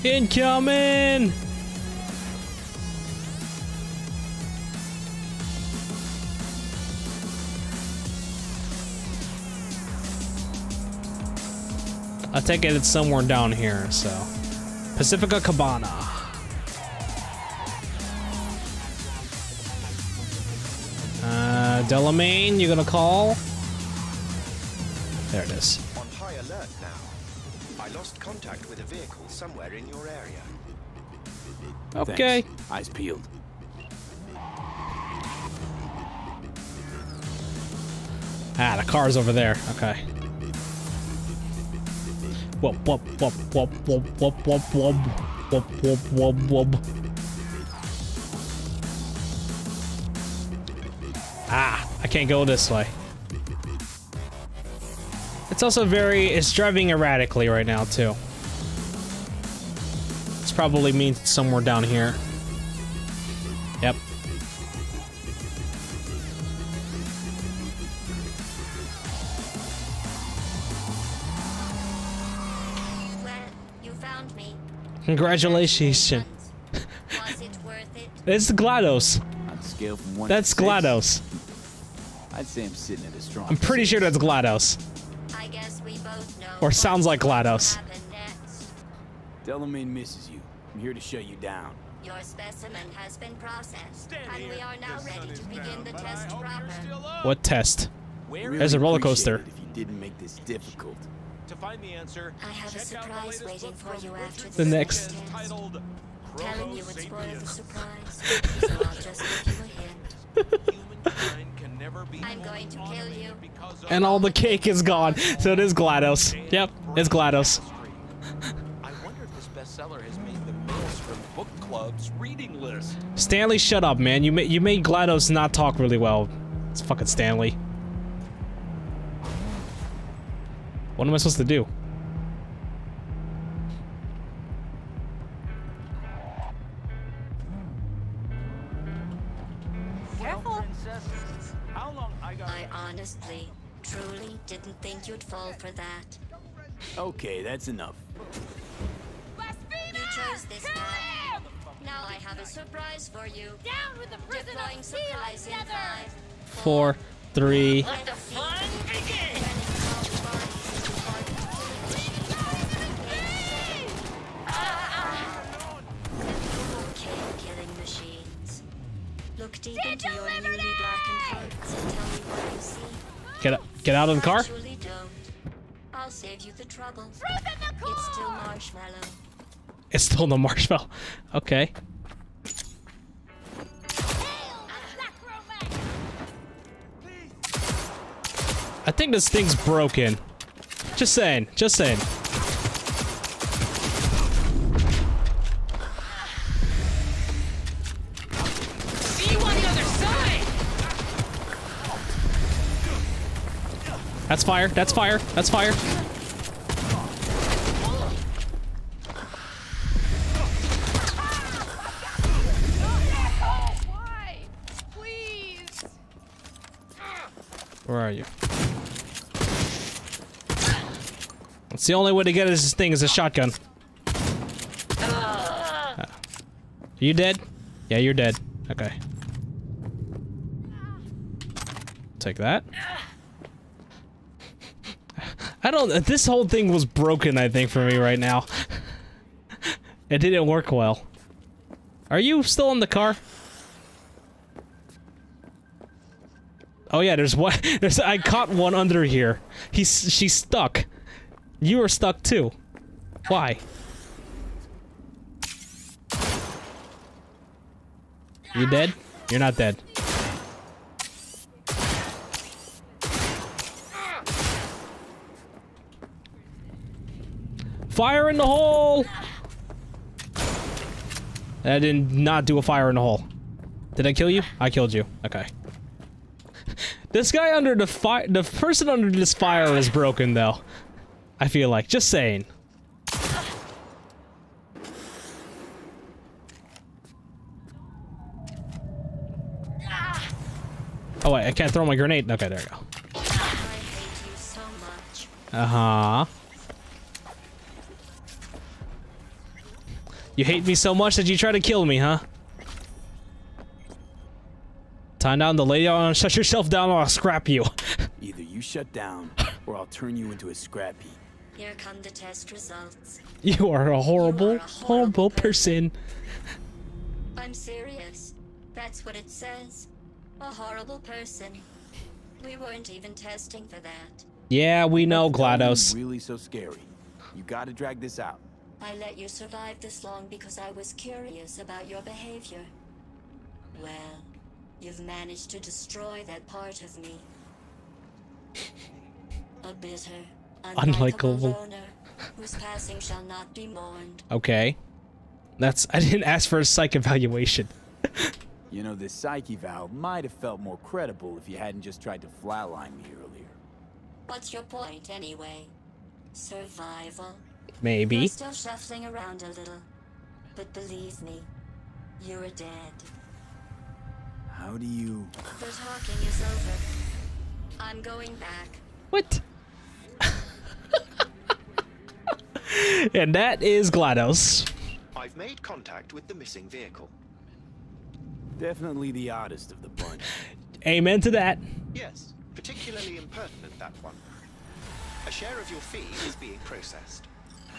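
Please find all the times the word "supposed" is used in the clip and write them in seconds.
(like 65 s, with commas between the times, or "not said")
131 s.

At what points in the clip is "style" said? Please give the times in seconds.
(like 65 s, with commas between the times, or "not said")
not said.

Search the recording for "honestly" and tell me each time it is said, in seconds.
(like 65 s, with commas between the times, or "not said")
142 s.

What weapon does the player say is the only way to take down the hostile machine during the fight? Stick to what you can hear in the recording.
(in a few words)
a shotgun.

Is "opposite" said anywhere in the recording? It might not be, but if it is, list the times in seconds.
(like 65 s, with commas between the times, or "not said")
not said.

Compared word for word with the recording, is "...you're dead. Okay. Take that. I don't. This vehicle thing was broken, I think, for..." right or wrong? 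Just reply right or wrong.
wrong.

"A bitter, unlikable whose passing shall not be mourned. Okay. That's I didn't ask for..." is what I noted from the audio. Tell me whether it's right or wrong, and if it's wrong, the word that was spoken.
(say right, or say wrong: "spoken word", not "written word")
right.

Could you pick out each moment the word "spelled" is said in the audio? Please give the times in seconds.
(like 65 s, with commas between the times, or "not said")
not said.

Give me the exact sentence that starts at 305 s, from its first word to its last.
Time down the lady on shut yourself down or I'll scrap you.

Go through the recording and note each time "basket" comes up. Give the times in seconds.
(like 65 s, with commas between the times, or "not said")
not said.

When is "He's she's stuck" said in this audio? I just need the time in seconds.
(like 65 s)
249 s.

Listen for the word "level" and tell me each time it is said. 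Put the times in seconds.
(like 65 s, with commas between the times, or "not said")
not said.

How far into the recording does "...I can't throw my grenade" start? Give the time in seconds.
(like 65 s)
291 s.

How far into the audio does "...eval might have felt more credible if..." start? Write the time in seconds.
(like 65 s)
349 s.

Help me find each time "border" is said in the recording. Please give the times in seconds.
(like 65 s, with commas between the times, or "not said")
not said.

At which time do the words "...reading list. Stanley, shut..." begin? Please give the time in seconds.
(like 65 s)
122 s.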